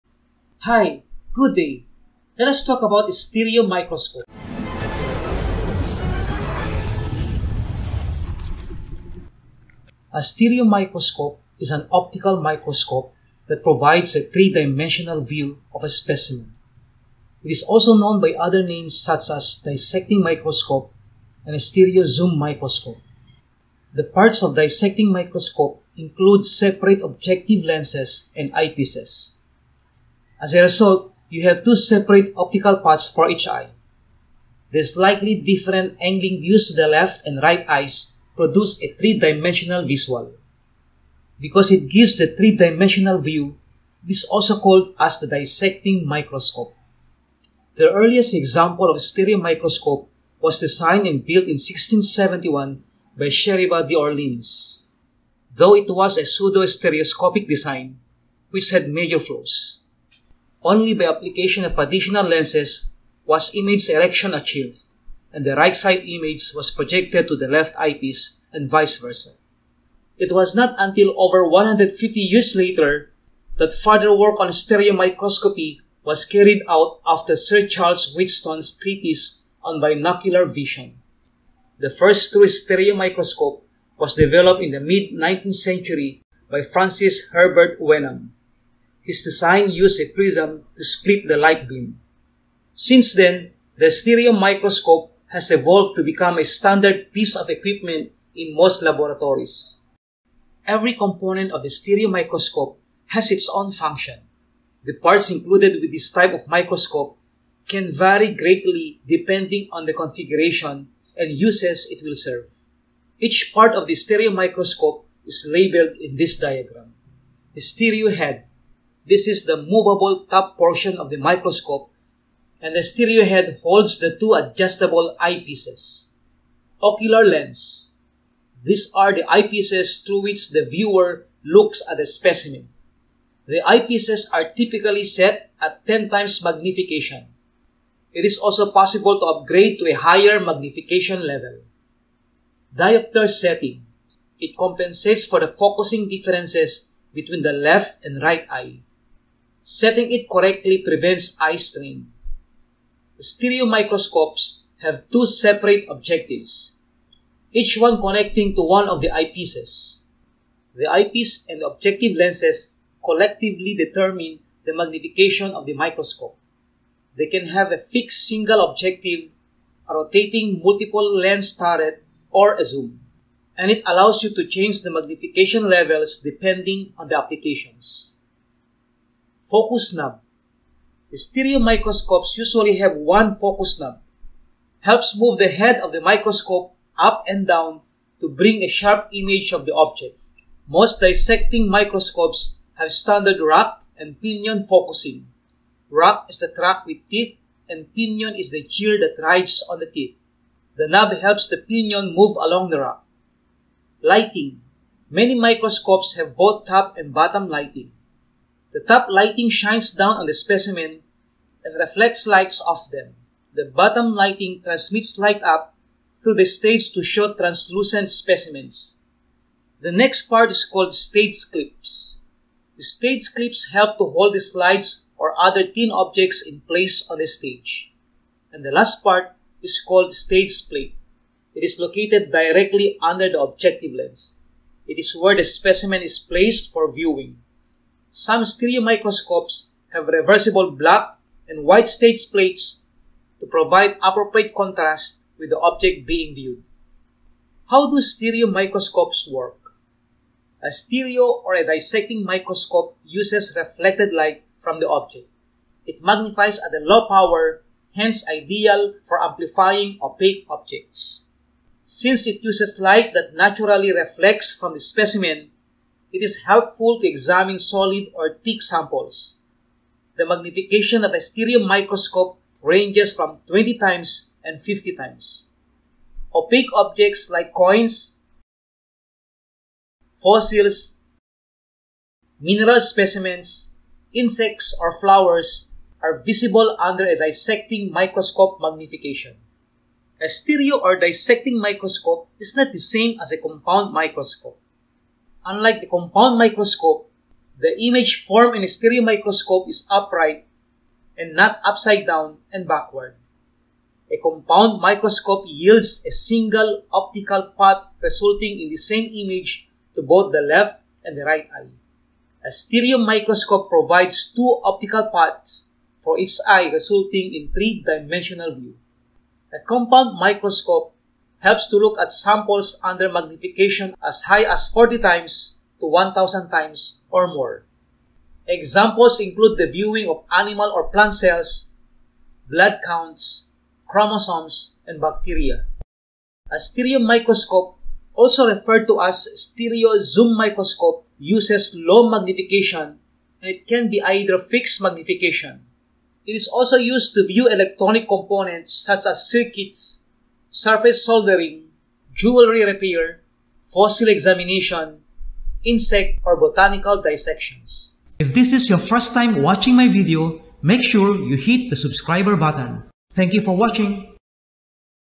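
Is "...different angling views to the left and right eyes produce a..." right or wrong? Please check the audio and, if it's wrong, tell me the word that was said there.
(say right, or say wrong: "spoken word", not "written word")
right.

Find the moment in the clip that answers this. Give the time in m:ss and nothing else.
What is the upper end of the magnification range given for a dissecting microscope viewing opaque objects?
4:34.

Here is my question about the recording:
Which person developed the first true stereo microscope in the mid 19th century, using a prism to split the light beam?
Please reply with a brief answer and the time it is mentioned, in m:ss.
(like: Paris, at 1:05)
Francis Herbert Wenham, at 1:26.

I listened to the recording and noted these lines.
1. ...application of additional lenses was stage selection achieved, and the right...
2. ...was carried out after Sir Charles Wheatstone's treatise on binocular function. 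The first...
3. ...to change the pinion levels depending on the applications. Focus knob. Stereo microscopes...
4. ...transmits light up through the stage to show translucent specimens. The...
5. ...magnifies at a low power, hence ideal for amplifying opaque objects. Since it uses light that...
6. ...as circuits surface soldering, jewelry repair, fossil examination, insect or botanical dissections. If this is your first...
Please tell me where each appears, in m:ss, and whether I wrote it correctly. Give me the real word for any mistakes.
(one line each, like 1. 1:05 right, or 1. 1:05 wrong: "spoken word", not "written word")
1. 1:01 wrong: "image", not "stage"
2. 1:16 wrong: "vision", not "function"
3. 2:54 wrong: "magnification", not "pinion"
4. 3:34 right
5. 4:16 right
6. 5:49 right.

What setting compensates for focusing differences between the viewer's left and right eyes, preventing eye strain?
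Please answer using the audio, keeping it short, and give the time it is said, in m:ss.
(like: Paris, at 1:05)
Diopter setting, at 2:22.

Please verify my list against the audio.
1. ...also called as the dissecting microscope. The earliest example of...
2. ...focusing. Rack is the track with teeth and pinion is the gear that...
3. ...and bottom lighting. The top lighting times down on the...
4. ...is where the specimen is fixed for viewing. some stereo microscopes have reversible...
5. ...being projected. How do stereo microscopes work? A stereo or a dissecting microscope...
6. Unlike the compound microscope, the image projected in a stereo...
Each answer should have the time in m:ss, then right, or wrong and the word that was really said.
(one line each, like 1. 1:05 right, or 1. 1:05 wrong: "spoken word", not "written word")
1. 0:44 right
2. 3:14 right
3. 3:26 wrong: "shines", not "times"
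4. 3:54 wrong: "placed", not "fixed"
5. 4:06 wrong: "viewed", not "projected"
6. 4:55 wrong: "formed", not "projected".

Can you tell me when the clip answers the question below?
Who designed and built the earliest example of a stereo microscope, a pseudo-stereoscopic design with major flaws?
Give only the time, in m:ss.
0:53.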